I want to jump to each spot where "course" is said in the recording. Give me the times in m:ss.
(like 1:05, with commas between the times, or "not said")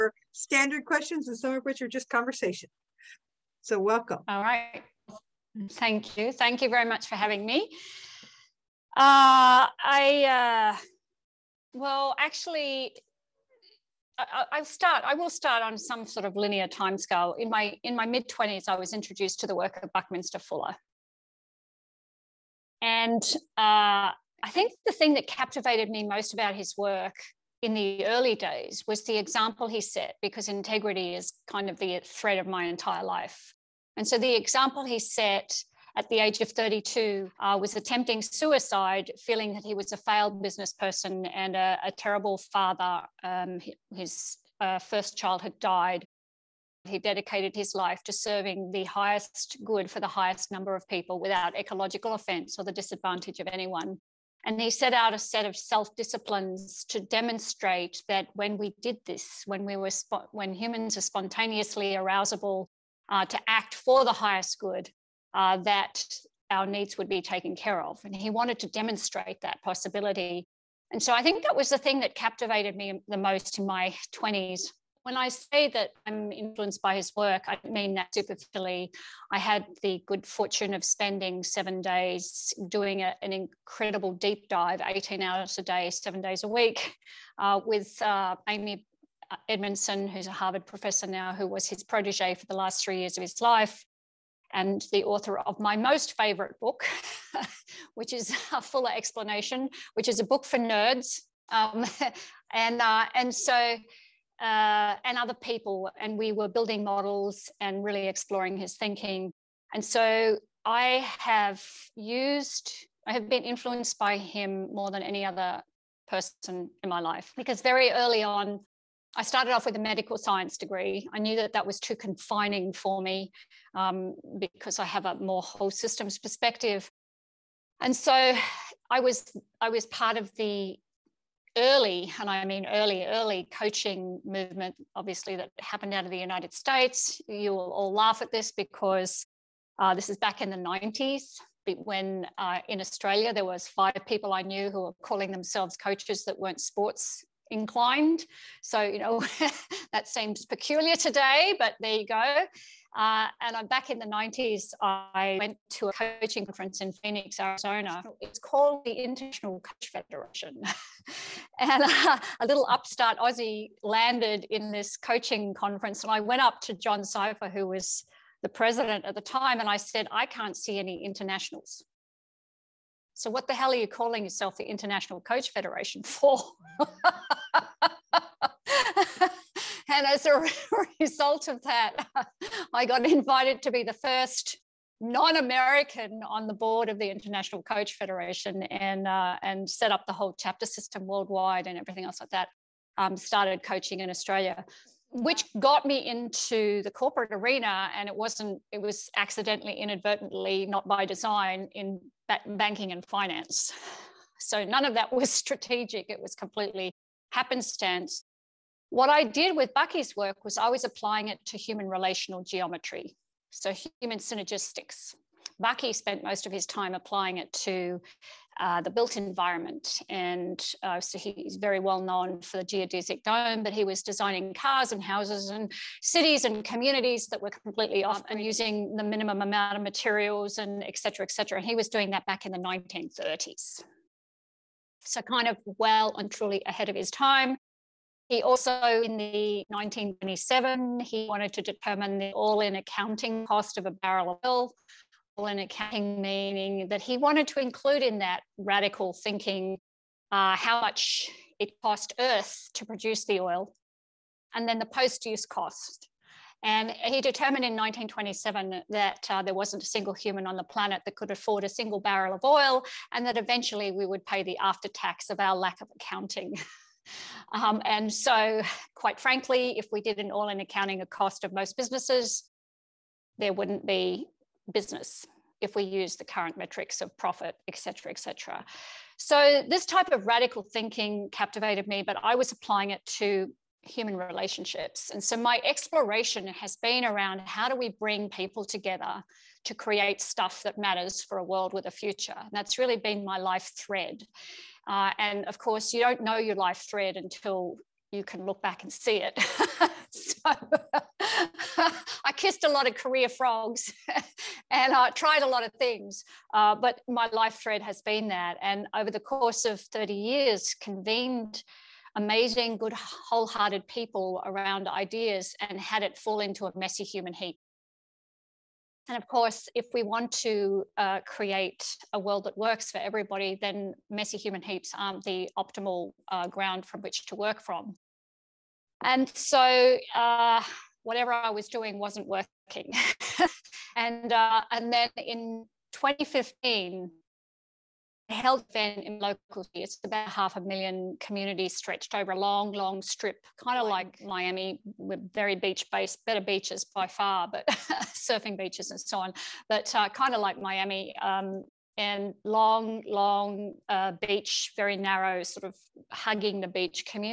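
4:55, 5:09, 5:19.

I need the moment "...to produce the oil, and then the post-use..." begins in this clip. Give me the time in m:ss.
4:12.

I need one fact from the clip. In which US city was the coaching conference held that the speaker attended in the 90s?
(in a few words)
Phoenix, Arizona.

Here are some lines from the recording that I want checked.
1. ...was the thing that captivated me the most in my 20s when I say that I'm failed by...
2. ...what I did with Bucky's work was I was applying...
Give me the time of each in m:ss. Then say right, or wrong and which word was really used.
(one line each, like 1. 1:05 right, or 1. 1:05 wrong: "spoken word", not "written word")
1. 1:11 wrong: "influenced", not "failed"
2. 3:28 right.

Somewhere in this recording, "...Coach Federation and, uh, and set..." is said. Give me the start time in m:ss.
3:07.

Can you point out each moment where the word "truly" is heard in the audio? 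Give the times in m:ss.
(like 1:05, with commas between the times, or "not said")
3:56.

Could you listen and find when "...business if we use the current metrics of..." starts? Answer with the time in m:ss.
4:34.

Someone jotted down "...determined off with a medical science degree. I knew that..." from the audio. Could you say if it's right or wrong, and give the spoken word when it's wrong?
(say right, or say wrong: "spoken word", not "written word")
wrong: "started", not "determined".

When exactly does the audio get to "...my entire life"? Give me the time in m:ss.
0:32.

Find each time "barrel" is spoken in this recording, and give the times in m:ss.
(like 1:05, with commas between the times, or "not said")
4:03, 4:22.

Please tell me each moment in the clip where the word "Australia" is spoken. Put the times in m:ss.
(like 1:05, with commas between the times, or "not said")
2:22, 3:14.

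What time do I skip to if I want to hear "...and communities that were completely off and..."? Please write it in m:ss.
3:46.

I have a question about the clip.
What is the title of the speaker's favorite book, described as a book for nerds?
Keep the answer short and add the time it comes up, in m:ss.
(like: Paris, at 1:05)
A Fuller Explanation, at 1:38.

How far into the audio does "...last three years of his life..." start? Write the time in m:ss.
1:32.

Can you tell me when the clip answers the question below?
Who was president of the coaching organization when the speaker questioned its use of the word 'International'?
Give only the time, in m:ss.
2:46.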